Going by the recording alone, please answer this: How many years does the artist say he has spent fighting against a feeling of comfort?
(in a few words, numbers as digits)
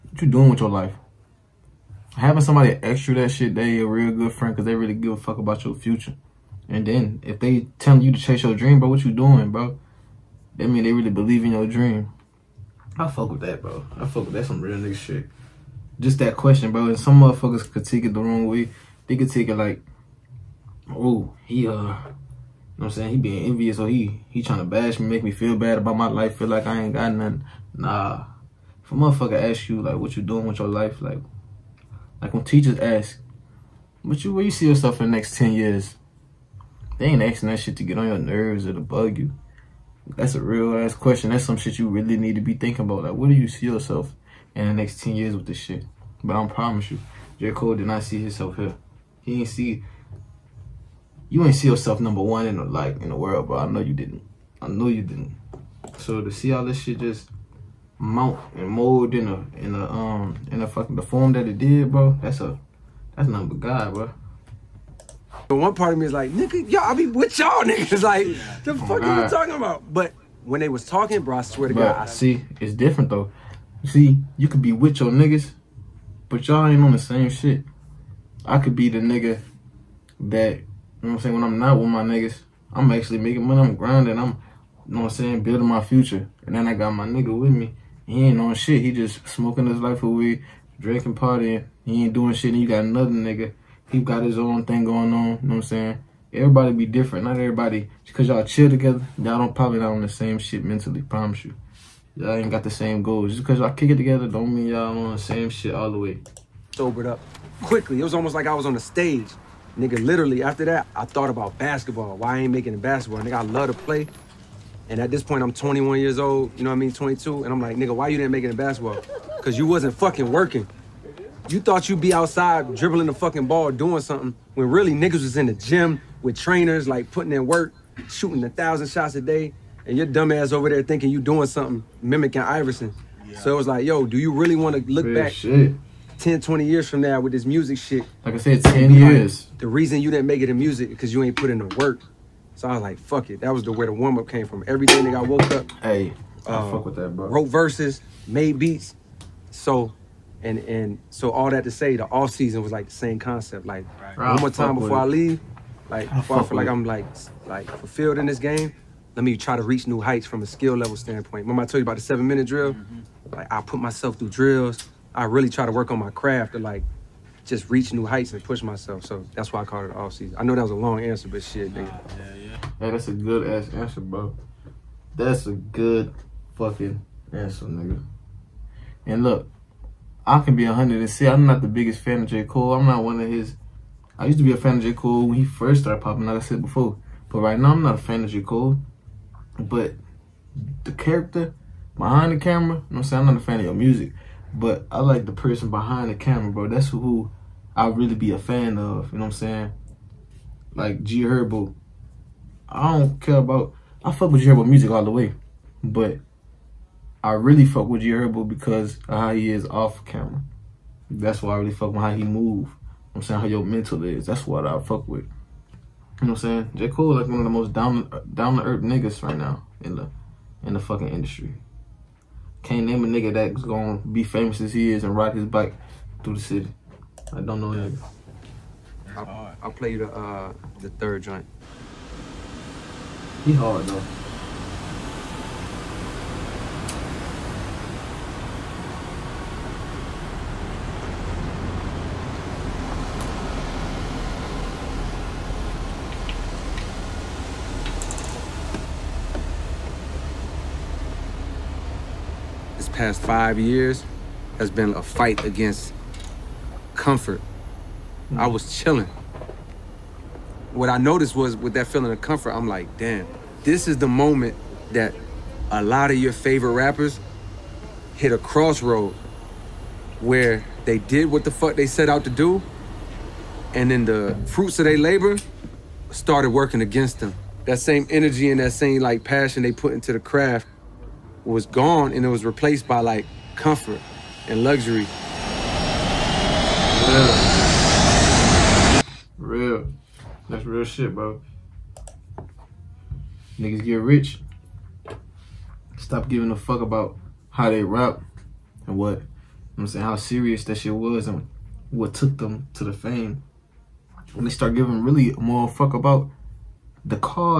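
5.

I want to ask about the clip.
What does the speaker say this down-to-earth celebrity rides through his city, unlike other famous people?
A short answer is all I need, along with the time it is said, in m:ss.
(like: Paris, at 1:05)
his bike, at 3:45.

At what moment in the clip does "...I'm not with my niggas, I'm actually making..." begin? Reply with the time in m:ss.
1:21.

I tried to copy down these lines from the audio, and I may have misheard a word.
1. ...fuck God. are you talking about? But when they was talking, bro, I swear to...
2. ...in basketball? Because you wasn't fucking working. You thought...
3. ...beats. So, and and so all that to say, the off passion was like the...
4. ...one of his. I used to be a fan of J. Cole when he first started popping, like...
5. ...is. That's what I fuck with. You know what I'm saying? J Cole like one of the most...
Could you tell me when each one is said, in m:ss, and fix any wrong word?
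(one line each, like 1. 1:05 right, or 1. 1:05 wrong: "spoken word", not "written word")
1. 1:08 right
2. 1:58 right
3. 2:28 wrong: "season", not "passion"
4. 3:03 right
5. 3:34 right.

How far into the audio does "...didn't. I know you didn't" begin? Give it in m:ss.
0:53.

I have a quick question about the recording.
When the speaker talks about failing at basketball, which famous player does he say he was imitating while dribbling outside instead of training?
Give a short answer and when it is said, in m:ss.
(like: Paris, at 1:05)
Iverson, at 2:12.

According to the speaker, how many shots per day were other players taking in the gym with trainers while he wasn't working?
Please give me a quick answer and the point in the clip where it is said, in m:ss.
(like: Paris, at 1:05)
1000, at 2:08.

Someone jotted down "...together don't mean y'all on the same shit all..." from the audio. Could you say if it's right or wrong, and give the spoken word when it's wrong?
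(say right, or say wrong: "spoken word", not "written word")
right.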